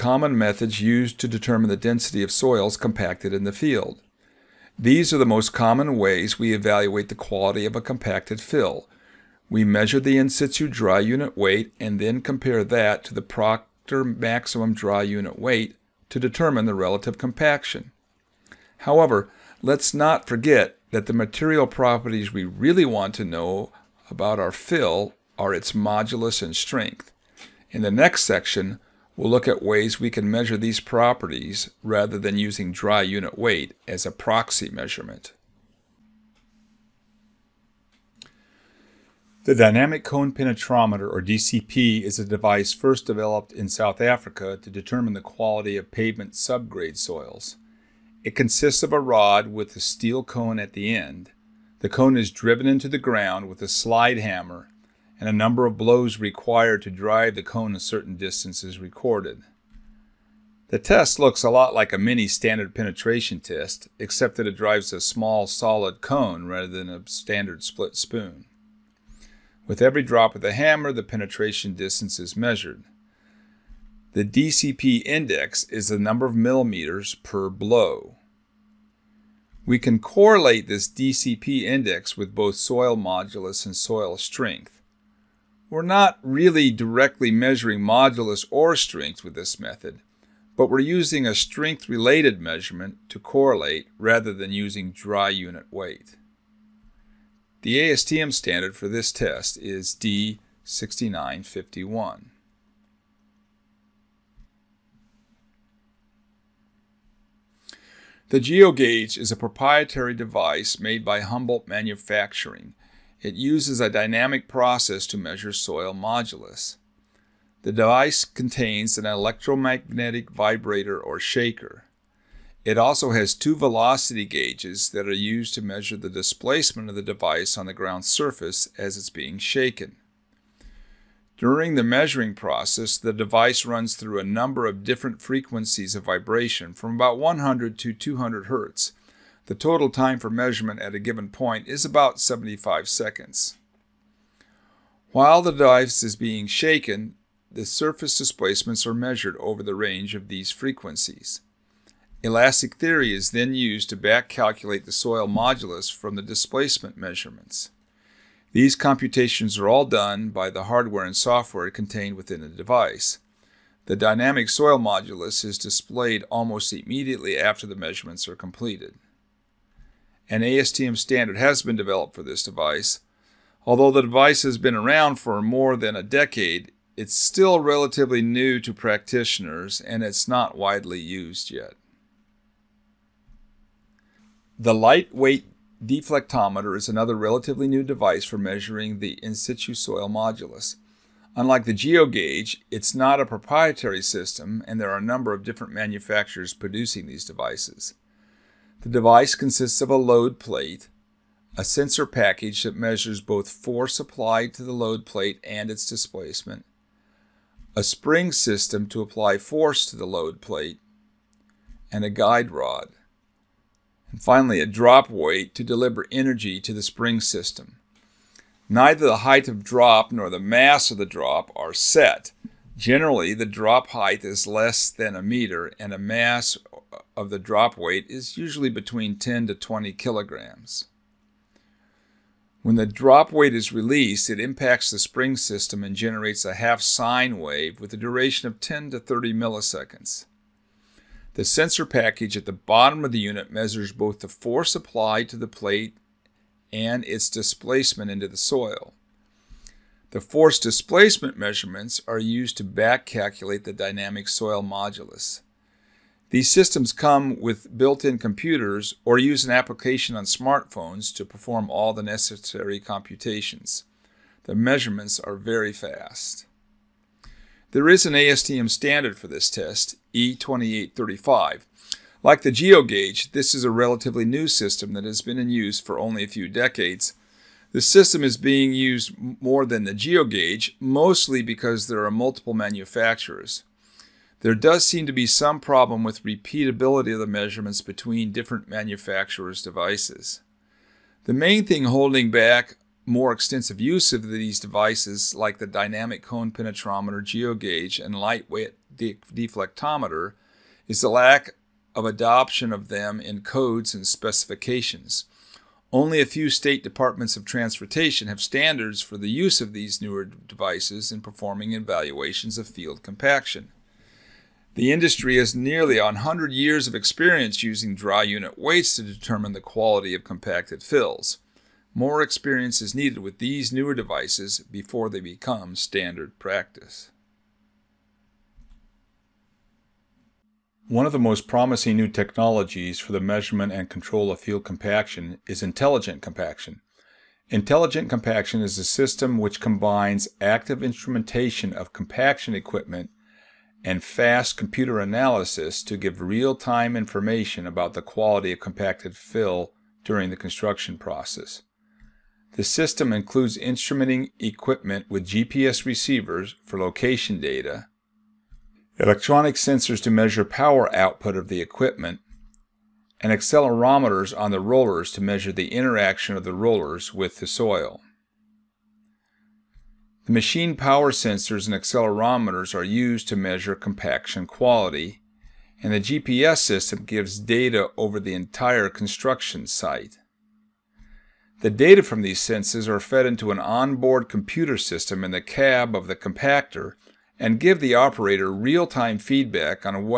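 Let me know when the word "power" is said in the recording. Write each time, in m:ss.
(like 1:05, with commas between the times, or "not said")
6:00, 6:10.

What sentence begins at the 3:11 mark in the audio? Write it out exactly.
Unlike the GeoGauge, it's not a proprietary system and there are a number of different manufacturers producing these devices.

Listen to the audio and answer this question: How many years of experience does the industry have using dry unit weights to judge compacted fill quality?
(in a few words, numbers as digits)
nearly 100 years.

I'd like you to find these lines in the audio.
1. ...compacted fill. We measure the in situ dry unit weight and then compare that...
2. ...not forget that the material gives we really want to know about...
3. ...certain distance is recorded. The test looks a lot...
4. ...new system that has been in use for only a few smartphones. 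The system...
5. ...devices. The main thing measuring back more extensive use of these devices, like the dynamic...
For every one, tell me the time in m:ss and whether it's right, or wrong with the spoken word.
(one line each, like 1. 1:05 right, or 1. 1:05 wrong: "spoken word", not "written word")
1. 0:07 right
2. 0:19 wrong: "properties", not "gives"
3. 0:57 right
4. 4:34 wrong: "decades", not "smartphones"
5. 4:49 wrong: "holding", not "measuring".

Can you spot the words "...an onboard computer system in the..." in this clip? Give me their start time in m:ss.
6:23.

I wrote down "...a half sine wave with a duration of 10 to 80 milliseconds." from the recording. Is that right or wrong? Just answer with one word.
wrong.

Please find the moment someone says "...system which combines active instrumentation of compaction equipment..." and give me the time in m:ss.
5:38.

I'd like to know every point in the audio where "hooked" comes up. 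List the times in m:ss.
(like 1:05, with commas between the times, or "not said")
not said.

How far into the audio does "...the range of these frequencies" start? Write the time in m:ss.
2:29.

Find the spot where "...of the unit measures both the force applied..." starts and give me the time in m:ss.
4:03.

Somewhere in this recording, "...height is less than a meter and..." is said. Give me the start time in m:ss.
3:43.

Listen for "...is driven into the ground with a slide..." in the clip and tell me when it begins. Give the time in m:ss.
0:52.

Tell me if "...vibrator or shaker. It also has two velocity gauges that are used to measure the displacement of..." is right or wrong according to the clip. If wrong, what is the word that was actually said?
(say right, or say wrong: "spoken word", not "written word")
right.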